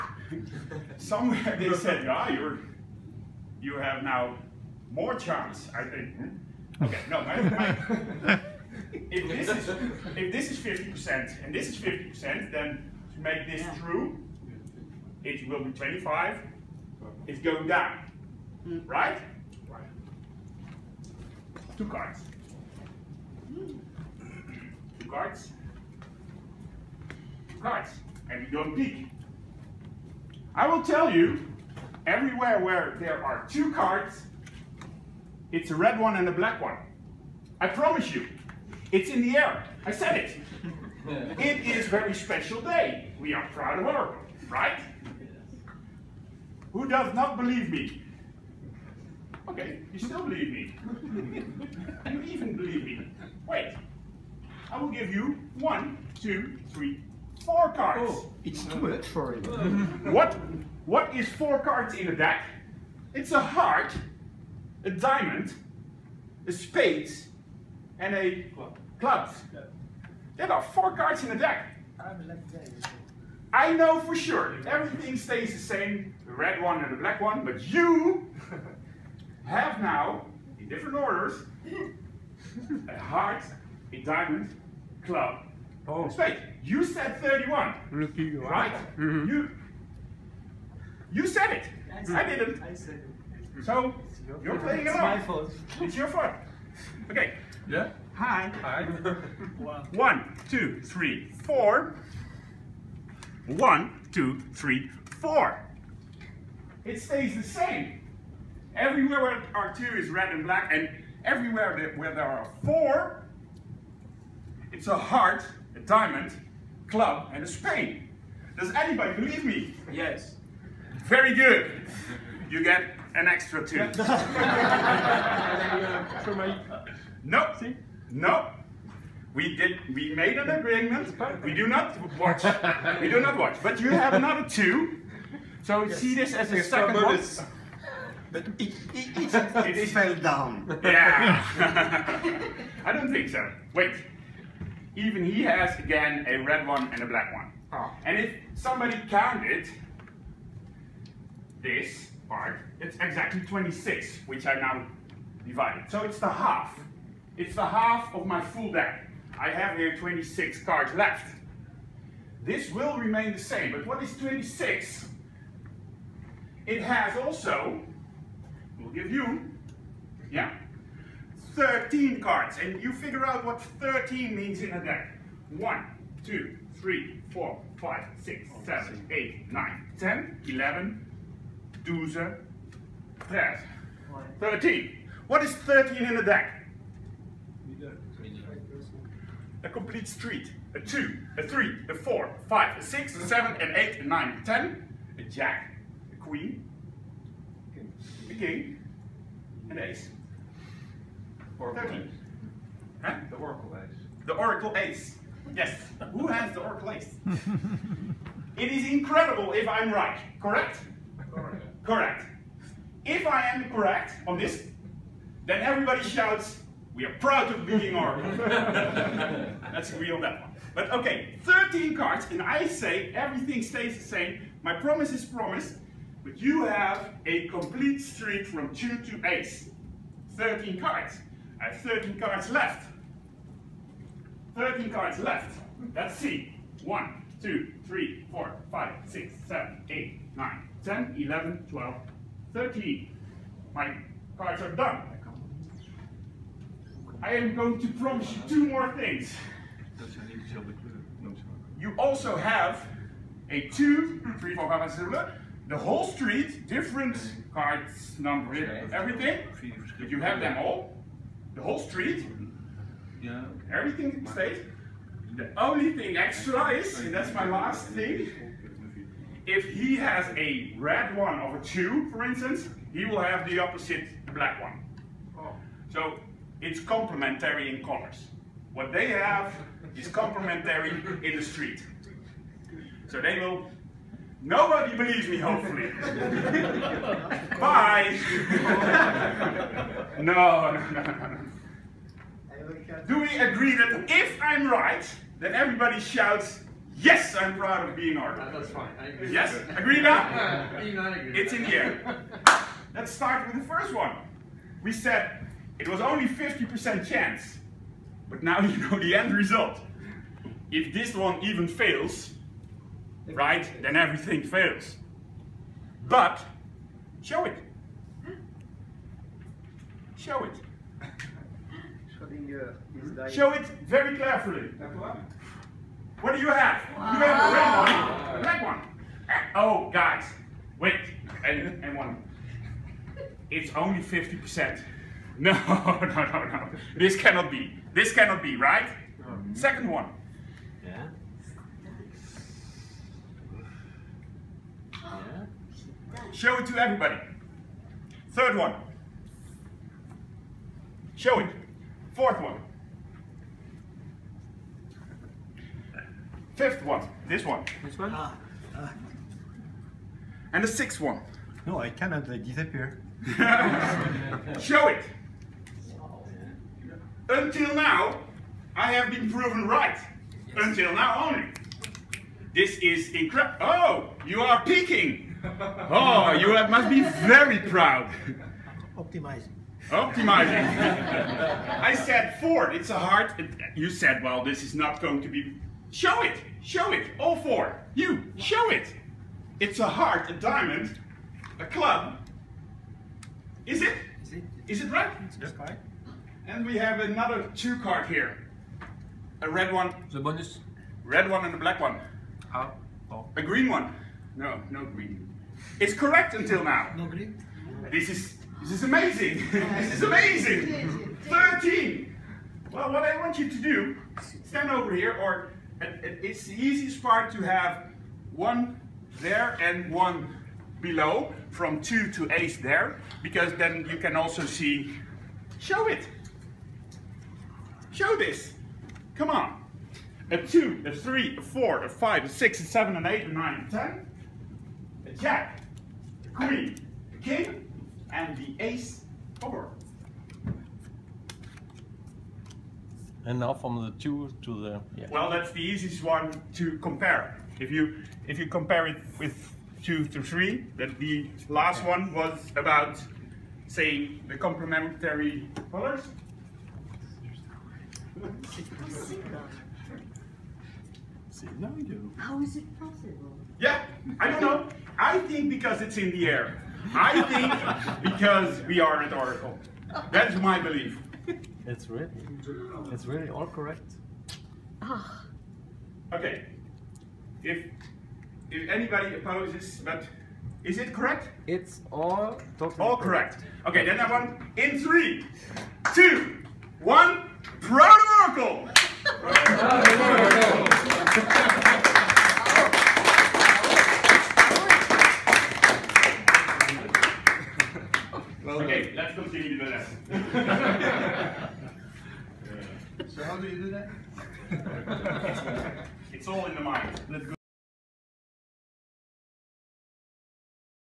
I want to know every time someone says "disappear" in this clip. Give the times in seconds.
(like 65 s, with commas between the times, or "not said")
362 s.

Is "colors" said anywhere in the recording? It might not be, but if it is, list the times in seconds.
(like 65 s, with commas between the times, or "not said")
455 s.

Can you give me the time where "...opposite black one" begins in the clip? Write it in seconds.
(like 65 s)
273 s.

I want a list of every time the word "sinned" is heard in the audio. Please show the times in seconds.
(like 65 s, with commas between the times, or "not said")
not said.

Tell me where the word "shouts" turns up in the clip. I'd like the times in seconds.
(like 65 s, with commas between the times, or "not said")
216 s, 295 s.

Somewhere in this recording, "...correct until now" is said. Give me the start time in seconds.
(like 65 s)
405 s.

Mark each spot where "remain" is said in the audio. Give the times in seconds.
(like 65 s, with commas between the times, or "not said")
162 s.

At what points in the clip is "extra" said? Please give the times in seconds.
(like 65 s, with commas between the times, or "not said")
123 s, 266 s.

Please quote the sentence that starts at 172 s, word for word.
And you figure out what 13 means in a deck.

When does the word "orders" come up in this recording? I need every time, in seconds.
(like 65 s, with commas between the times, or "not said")
80 s.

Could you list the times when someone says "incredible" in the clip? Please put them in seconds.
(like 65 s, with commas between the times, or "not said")
208 s, 373 s.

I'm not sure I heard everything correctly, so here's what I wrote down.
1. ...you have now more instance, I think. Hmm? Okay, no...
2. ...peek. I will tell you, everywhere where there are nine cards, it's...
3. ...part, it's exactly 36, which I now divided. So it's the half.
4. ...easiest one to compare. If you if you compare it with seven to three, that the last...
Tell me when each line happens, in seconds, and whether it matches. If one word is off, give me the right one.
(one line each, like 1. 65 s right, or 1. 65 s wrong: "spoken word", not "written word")
1. 3 s wrong: "chance", not "instance"
2. 28 s wrong: "two", not "nine"
3. 152 s wrong: "26", not "36"
4. 445 s wrong: "two", not "seven".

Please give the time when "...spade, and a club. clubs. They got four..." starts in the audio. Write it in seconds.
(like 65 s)
66 s.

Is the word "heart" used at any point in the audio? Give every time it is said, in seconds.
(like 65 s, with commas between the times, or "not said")
63 s, 82 s, 114 s, 389 s.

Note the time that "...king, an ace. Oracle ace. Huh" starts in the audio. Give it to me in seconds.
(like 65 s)
198 s.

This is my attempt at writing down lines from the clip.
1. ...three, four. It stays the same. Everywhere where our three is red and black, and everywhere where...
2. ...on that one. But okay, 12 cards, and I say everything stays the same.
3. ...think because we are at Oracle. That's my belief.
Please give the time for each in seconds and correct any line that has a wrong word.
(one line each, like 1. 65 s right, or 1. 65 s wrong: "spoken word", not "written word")
1. 104 s wrong: "two", not "three"
2. 220 s wrong: "13", not "12"
3. 467 s right.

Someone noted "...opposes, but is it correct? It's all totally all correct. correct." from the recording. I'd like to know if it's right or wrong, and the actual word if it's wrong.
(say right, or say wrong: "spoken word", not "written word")
right.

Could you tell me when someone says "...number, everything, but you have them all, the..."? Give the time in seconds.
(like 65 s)
258 s.